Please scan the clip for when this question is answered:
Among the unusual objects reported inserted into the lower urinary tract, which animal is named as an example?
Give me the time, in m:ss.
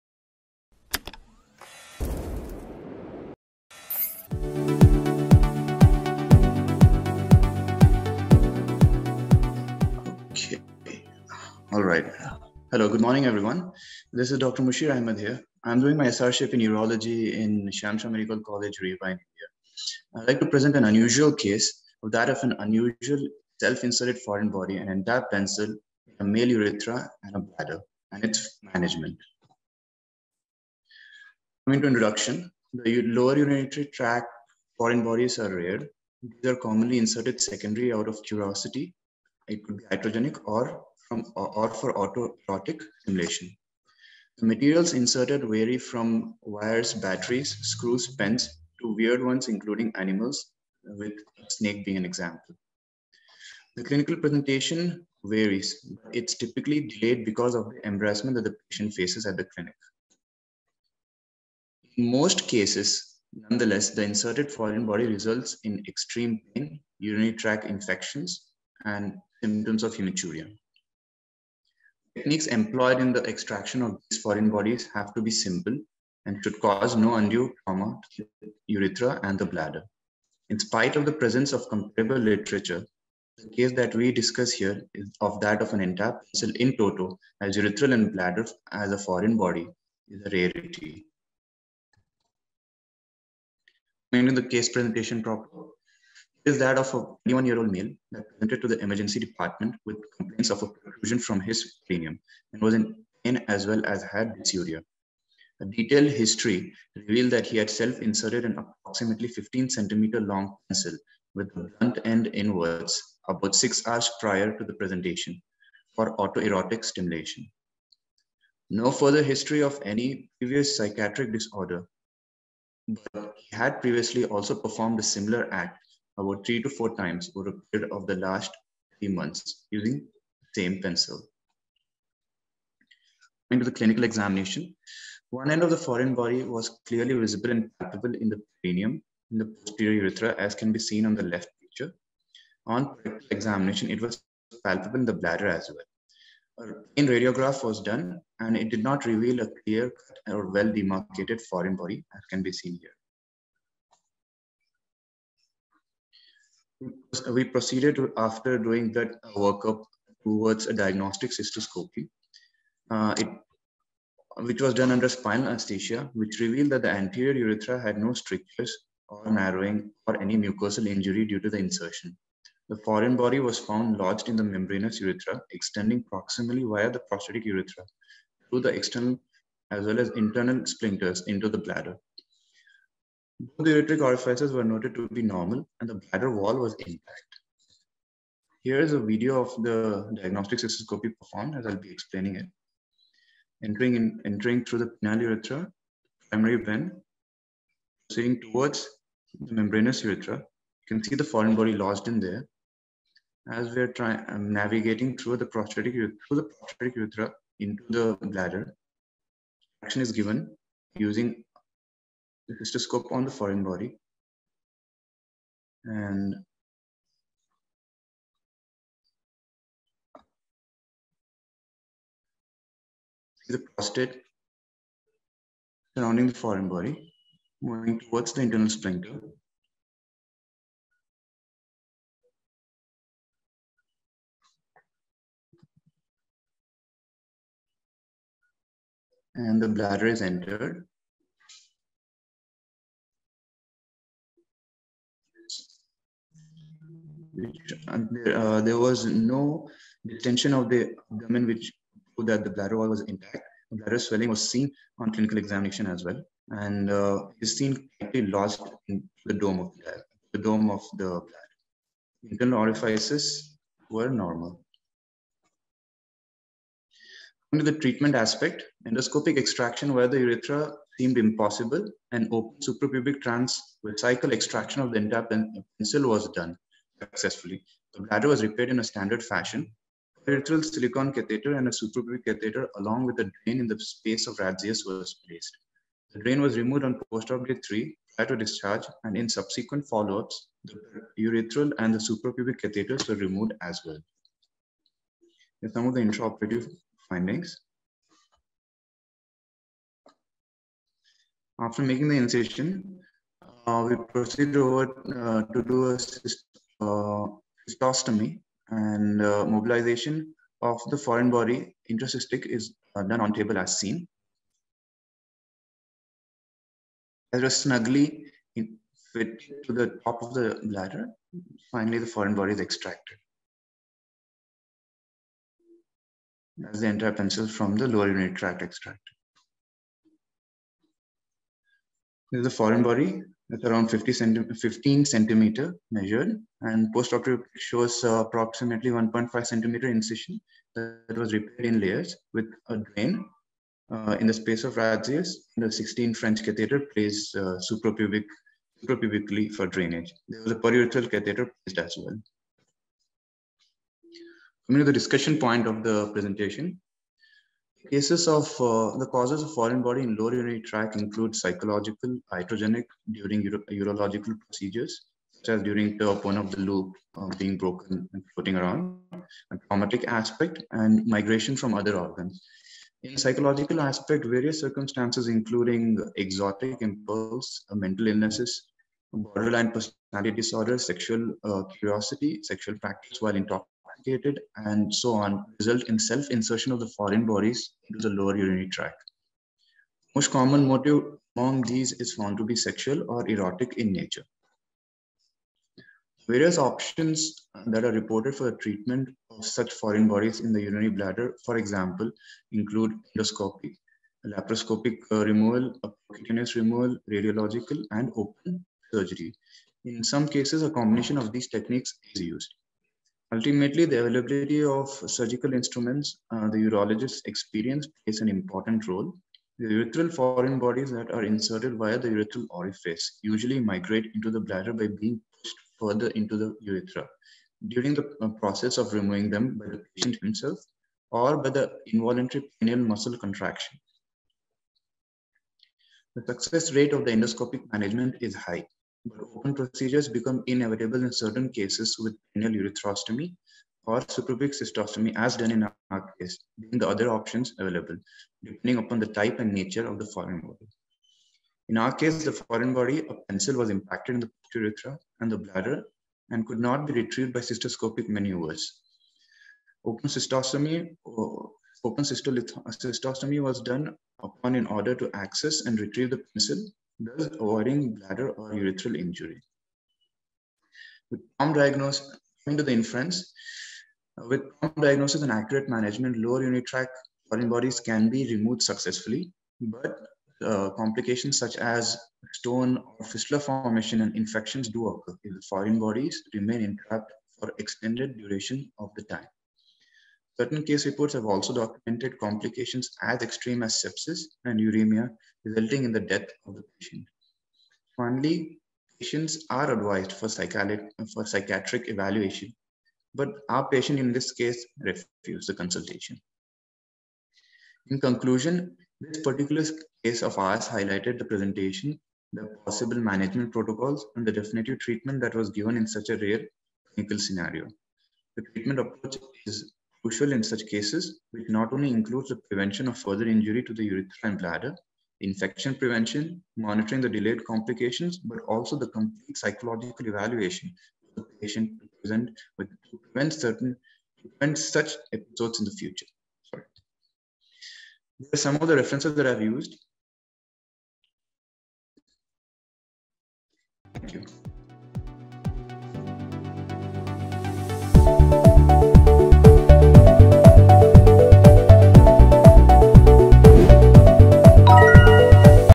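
0:51.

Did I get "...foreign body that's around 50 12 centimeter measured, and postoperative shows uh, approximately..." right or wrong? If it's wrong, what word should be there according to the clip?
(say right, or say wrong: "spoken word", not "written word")
wrong: "15", not "12".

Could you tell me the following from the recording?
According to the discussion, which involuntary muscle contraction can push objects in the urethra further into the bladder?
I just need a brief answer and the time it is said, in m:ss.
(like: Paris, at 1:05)
Pineal muscle contraction, at 7:12.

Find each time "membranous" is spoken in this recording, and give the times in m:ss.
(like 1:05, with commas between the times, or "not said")
2:54, 3:19.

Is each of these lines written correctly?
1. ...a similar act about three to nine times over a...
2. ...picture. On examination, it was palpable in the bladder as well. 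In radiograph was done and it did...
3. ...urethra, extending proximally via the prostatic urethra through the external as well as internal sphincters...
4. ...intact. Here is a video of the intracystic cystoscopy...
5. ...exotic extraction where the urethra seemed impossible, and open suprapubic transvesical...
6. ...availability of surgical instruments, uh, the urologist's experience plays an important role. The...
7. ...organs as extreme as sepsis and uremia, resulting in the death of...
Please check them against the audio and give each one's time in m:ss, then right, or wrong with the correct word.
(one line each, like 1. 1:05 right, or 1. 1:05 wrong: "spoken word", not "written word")
1. 2:04 wrong: "four", not "nine"
2. 2:21 right
3. 2:55 right
4. 3:06 wrong: "diagnostic", not "intracystic"
5. 4:28 wrong: "endoscopic", not "exotic"
6. 6:54 right
7. 8:12 wrong: "complications", not "organs".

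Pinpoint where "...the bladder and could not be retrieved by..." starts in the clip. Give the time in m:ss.
7:35.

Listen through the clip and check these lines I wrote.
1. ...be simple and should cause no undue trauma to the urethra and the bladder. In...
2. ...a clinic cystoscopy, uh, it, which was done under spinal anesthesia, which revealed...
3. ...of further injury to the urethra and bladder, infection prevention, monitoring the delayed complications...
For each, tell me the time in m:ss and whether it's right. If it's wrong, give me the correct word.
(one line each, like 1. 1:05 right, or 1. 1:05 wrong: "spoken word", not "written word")
1. 1:15 right
2. 2:40 wrong: "diagnostic", not "clinic"
3. 8:42 right.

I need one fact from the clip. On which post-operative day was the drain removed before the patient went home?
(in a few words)
Day 3.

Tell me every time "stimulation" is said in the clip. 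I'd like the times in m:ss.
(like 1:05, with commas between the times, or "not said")
0:43, 1:56.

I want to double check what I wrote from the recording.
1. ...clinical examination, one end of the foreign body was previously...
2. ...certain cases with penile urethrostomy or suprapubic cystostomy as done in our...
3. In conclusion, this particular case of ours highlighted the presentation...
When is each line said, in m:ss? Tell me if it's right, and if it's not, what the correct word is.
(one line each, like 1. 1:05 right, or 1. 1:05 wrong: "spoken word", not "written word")
1. 2:13 wrong: "clearly", not "previously"
2. 7:21 right
3. 8:27 right.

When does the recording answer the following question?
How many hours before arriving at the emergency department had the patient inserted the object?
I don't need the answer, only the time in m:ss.
1:53.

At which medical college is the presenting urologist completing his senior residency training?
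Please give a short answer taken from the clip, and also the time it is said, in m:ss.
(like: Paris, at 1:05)
Shyam Shah Medical College, at 0:17.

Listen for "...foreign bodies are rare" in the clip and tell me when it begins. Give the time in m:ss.
0:34.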